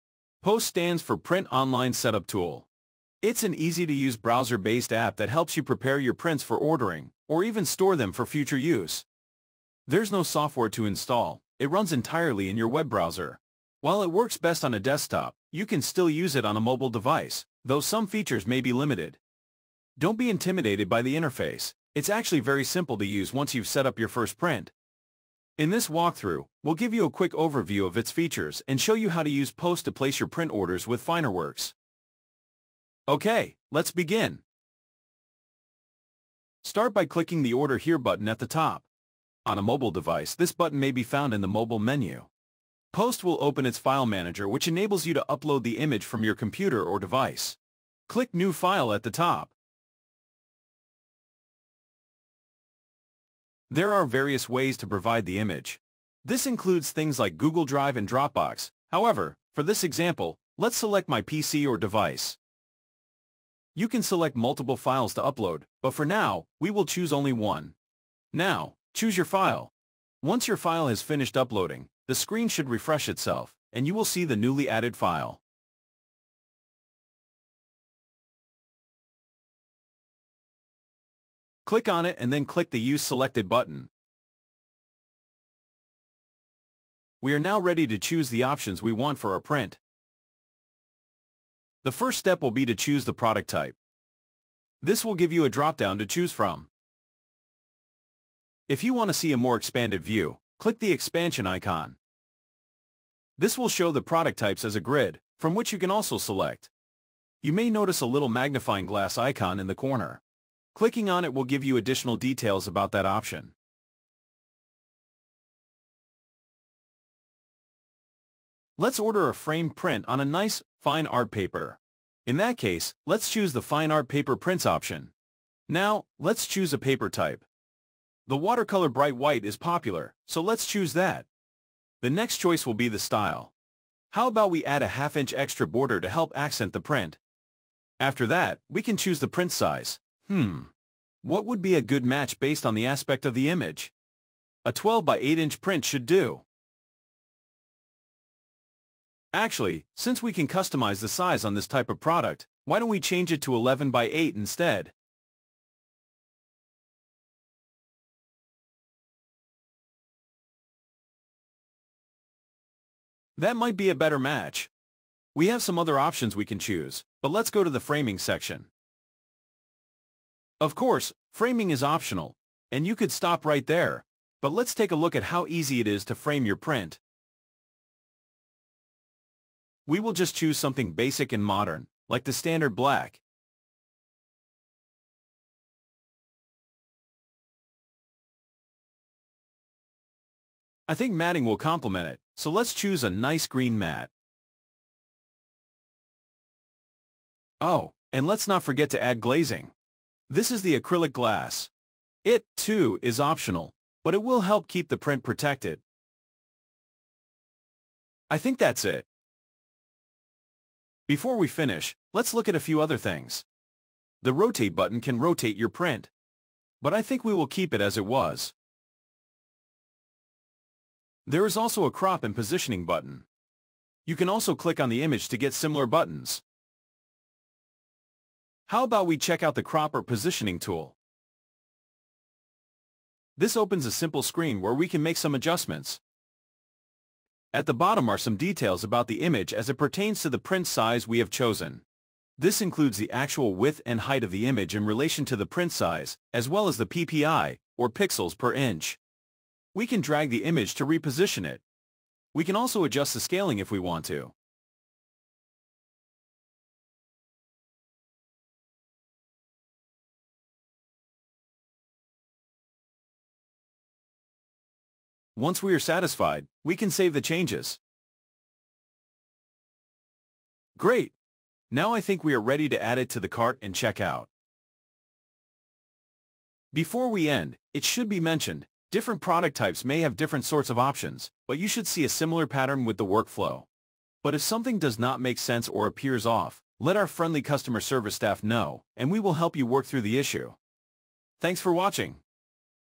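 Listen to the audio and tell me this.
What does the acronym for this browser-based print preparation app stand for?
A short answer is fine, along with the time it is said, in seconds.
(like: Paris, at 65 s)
Print Online Setup Tool, at 1 s.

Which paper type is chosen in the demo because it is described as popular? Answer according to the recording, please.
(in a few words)
watercolor bright white.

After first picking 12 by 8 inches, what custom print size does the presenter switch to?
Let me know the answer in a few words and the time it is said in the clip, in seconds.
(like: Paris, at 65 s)
11 by 8, at 153 s.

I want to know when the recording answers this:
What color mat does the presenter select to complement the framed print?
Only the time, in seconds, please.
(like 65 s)
193 s.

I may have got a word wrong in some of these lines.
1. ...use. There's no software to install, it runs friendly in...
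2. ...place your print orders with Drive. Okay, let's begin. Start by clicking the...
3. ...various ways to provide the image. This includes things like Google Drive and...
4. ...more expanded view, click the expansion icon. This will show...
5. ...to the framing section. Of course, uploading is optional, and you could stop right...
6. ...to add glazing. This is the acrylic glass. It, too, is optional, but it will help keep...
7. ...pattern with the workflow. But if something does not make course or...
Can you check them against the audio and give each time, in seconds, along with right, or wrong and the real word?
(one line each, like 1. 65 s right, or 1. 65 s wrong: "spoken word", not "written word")
1. 8 s wrong: "entirely", not "friendly"
2. 29 s wrong: "Finerworks", not "Drive"
3. 54 s right
4. 99 s right
5. 167 s wrong: "framing", not "uploading"
6. 198 s right
7. 282 s wrong: "sense", not "course".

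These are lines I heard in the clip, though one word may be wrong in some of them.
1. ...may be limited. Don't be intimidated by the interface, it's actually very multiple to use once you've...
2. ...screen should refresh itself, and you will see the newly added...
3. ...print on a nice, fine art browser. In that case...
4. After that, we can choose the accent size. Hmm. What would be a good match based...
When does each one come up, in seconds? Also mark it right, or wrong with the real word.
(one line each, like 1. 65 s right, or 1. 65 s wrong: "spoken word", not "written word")
1. 18 s wrong: "simple", not "multiple"
2. 72 s right
3. 119 s wrong: "paper", not "browser"
4. 137 s wrong: "print", not "accent".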